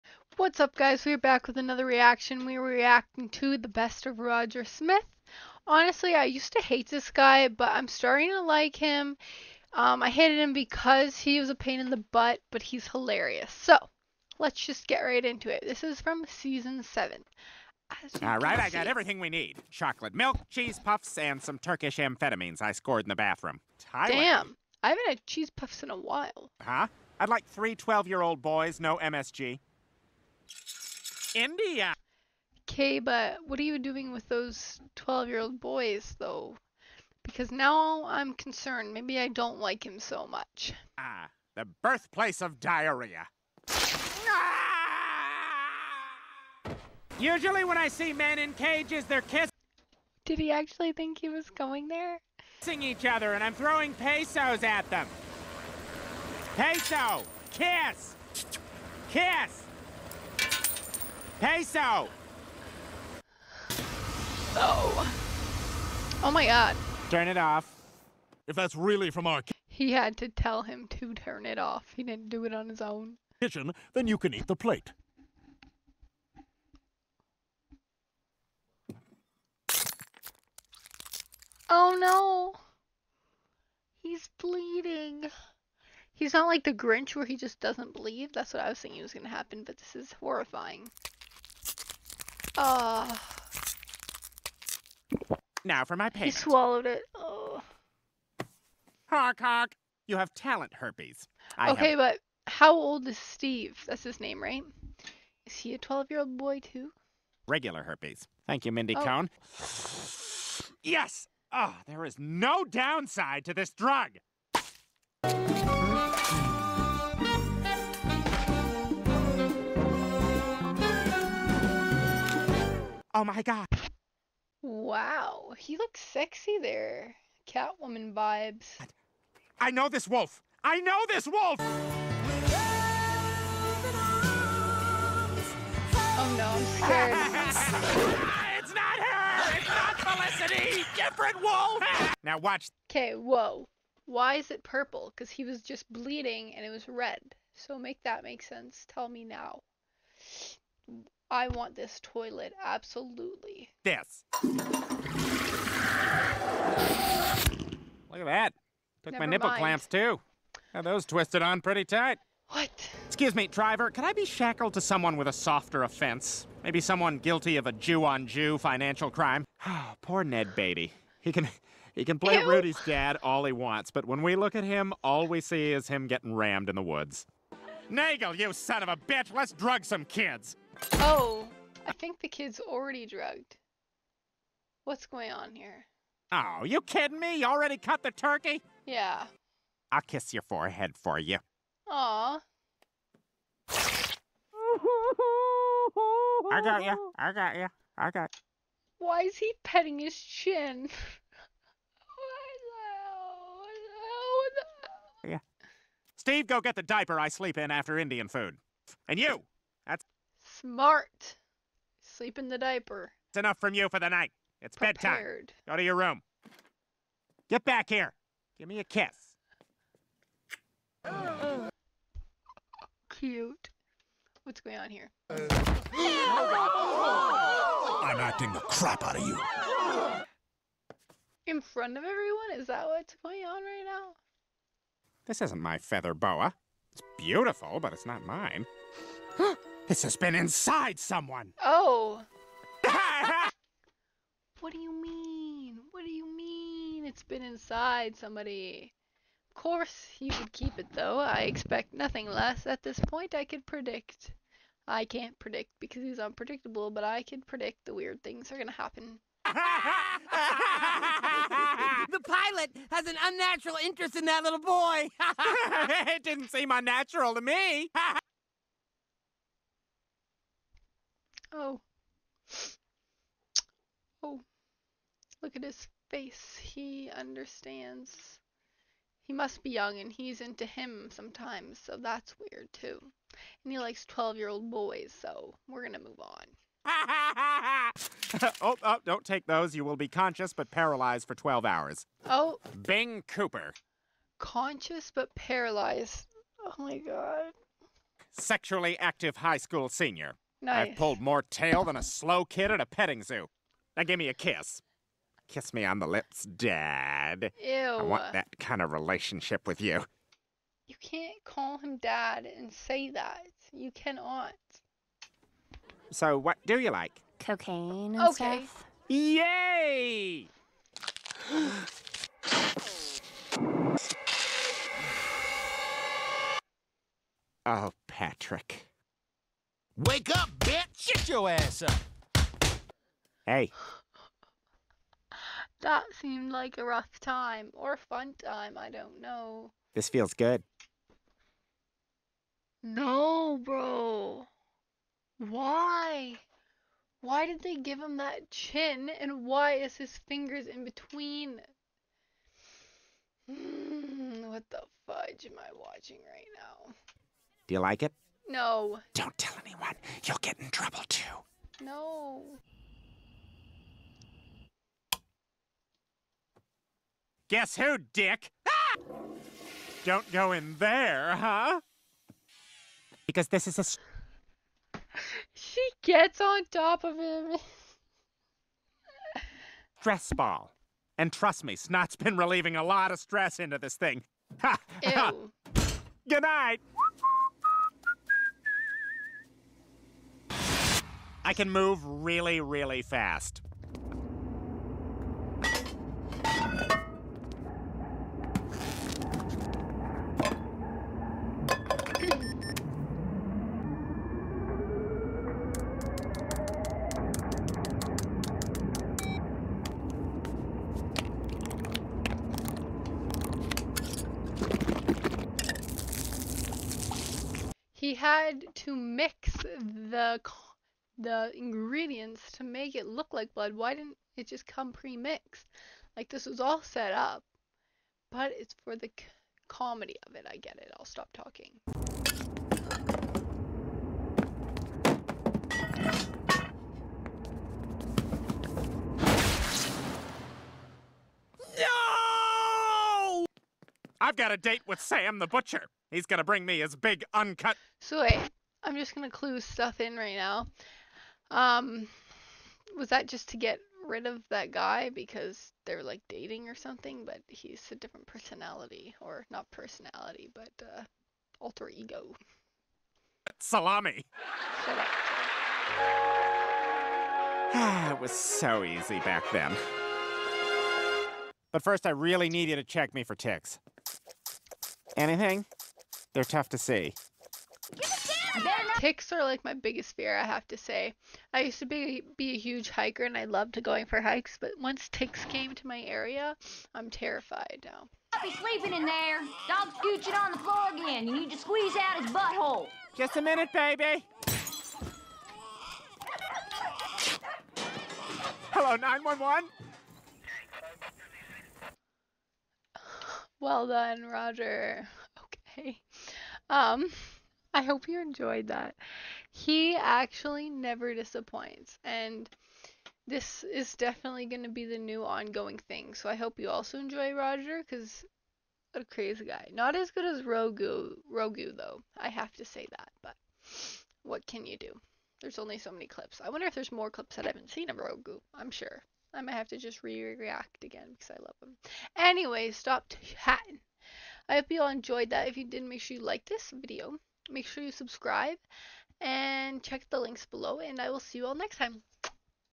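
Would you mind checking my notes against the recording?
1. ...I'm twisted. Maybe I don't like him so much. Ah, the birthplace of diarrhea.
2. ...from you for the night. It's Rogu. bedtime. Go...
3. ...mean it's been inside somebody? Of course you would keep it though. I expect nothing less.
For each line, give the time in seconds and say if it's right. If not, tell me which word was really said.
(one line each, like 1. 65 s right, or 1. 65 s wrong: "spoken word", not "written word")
1. 38 s wrong: "concerned", not "twisted"
2. 213 s wrong: "Prepared", not "Rogu"
3. 246 s right.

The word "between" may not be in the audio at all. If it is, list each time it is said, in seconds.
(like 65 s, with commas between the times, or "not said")
350 s.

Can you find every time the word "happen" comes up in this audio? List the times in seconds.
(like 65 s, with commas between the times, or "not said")
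89 s, 258 s.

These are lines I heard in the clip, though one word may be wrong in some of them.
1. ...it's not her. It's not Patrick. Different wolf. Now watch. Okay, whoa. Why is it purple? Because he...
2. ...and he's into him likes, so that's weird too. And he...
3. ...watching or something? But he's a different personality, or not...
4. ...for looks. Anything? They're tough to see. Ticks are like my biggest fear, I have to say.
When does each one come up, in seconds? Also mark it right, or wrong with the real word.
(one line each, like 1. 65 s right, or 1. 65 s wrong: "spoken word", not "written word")
1. 138 s wrong: "Felicity", not "Patrick"
2. 279 s wrong: "sometimes", not "likes"
3. 456 s wrong: "dating", not "watching"
4. 473 s wrong: "ticks", not "looks".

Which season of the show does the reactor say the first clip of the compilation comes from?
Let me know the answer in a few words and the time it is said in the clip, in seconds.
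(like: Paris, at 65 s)
Season 7, at 16 s.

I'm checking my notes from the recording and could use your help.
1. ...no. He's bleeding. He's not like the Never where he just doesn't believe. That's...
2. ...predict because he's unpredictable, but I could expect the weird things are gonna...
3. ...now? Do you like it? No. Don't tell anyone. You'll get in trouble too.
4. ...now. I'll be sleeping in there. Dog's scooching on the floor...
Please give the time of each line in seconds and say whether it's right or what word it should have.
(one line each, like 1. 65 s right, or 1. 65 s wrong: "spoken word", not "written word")
1. 81 s wrong: "Grinch", not "Never"
2. 255 s wrong: "predict", not "expect"
3. 356 s right
4. 487 s right.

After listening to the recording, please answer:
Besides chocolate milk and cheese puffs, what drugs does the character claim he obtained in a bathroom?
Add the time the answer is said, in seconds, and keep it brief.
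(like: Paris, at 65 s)
Turkish amphetamines, at 21 s.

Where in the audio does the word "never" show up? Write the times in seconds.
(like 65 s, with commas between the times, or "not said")
159 s, 510 s.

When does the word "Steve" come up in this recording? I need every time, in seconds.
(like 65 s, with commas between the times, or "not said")
103 s, 206 s.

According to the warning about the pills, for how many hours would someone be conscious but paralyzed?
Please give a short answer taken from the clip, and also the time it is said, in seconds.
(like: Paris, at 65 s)
12, at 291 s.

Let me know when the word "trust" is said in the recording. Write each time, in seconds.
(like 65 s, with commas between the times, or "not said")
381 s.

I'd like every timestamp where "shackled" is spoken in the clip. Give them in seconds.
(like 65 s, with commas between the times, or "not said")
164 s.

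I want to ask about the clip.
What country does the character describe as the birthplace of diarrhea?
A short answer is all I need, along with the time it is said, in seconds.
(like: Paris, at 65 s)
India, at 31 s.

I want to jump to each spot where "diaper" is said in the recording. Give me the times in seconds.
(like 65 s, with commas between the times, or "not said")
206 s, 212 s.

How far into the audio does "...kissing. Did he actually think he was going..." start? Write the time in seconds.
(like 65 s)
49 s.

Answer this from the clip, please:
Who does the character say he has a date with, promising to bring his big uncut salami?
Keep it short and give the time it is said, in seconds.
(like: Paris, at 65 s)
Sam the butcher, at 444 s.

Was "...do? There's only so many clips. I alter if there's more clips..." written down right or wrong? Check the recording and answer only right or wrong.
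wrong.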